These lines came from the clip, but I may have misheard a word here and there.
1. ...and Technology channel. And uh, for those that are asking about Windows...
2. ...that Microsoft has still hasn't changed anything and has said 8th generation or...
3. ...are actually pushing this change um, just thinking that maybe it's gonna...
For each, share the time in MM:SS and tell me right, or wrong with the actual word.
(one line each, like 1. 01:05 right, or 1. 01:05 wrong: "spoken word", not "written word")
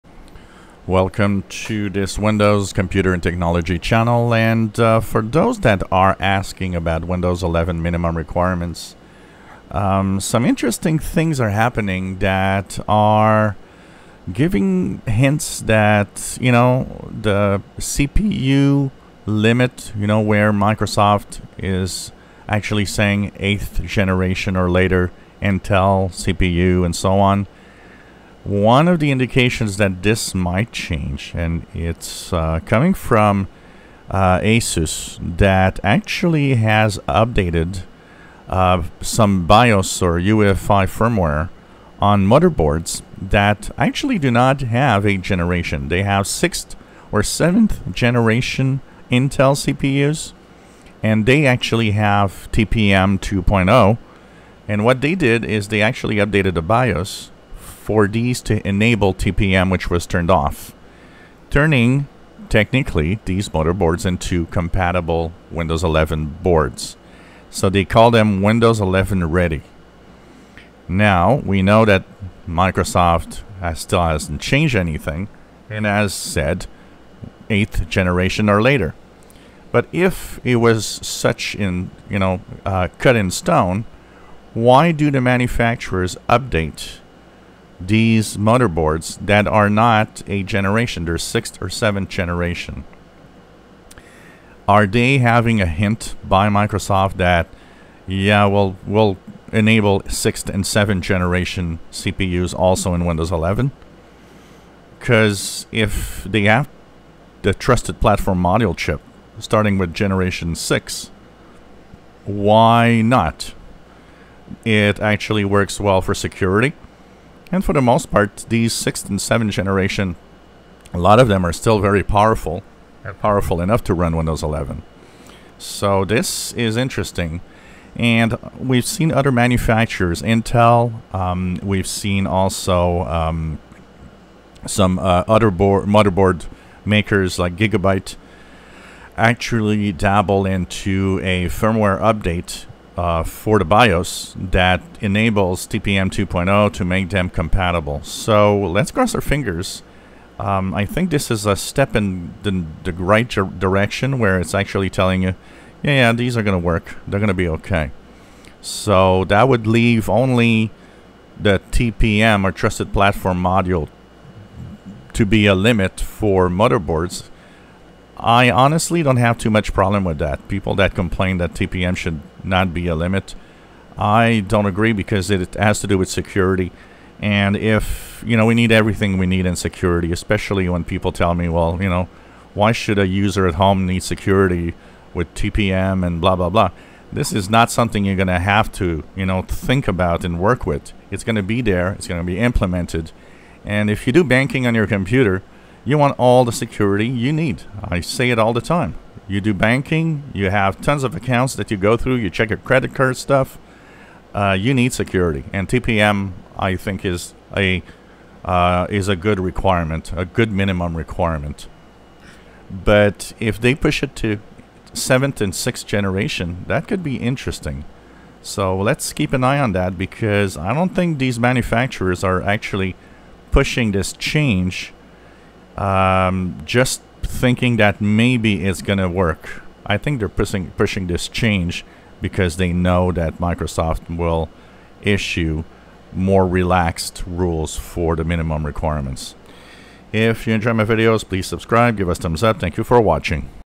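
1. 00:03 right
2. 01:11 right
3. 03:42 right.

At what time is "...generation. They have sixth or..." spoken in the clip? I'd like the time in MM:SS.
00:45.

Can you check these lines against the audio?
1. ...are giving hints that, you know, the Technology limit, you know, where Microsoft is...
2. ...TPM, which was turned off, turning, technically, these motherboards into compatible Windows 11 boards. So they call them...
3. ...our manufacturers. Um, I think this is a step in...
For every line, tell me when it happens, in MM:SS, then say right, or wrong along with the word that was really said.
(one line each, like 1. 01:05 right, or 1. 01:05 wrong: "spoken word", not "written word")
1. 00:12 wrong: "CPU", not "Technology"
2. 00:59 right
3. 02:29 wrong: "fingers", not "manufacturers".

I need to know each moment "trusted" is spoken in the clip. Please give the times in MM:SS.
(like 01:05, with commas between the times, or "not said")
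01:47, 02:42.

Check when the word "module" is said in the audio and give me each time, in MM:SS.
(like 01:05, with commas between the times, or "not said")
01:48, 02:43.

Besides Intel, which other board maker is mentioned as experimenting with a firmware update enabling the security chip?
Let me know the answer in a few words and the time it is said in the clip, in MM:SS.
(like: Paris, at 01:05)
Gigabyte, at 02:17.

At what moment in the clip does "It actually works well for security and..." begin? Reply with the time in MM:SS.
01:54.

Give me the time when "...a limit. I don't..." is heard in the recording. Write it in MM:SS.
02:52.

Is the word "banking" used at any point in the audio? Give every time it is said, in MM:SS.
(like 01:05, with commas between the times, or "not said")
03:14, 03:19.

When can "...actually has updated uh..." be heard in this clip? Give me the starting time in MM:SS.
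00:35.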